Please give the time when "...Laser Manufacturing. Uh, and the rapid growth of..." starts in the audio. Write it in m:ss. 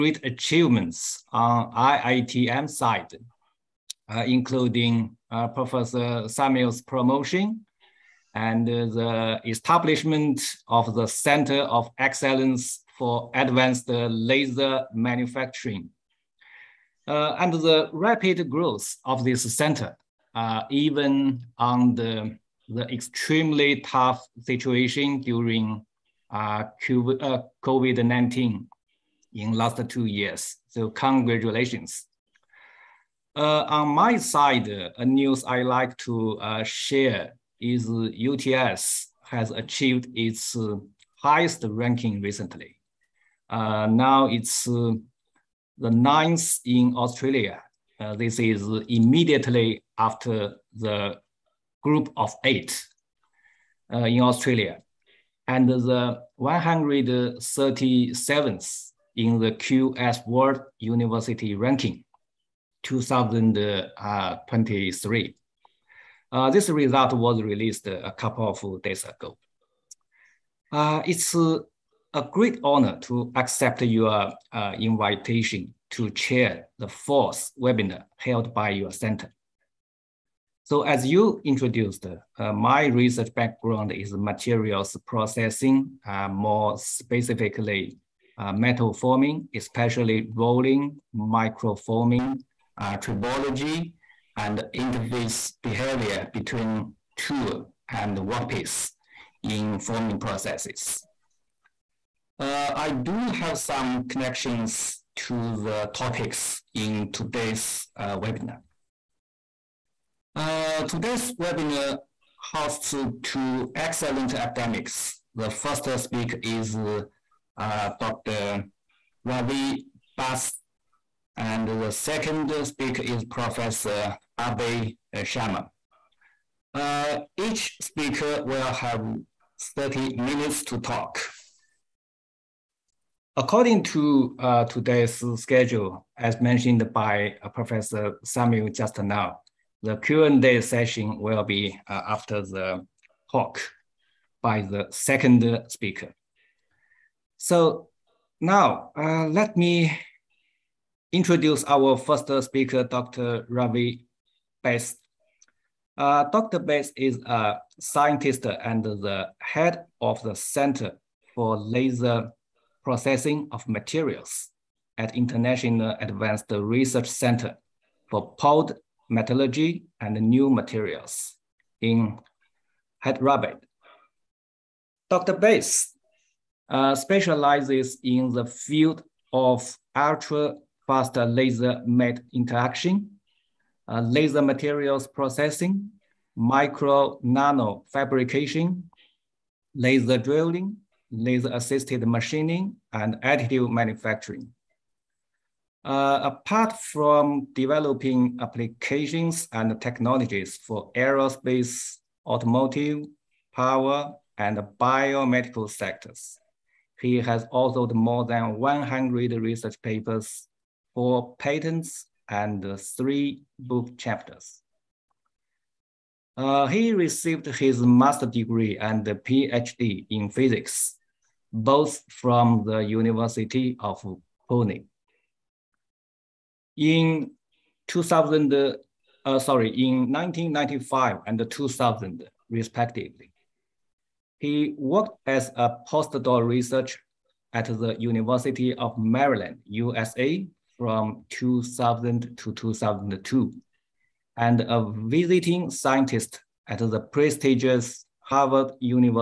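0:13.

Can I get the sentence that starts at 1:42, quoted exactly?
Uh, I do have some connections to the topics in today's uh, webinar.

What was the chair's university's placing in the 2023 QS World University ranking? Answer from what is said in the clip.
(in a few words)
137th.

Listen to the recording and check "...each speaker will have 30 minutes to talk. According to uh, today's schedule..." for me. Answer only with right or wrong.
right.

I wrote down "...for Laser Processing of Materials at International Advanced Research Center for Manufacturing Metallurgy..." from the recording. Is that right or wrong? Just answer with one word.
wrong.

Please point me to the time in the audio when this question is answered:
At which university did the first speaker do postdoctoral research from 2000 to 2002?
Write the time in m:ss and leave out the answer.
3:57.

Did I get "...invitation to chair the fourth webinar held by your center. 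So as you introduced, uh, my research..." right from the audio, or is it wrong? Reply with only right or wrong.
right.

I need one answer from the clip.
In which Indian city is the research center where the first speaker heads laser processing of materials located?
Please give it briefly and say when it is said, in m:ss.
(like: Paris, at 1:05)
Hyderabad, at 2:53.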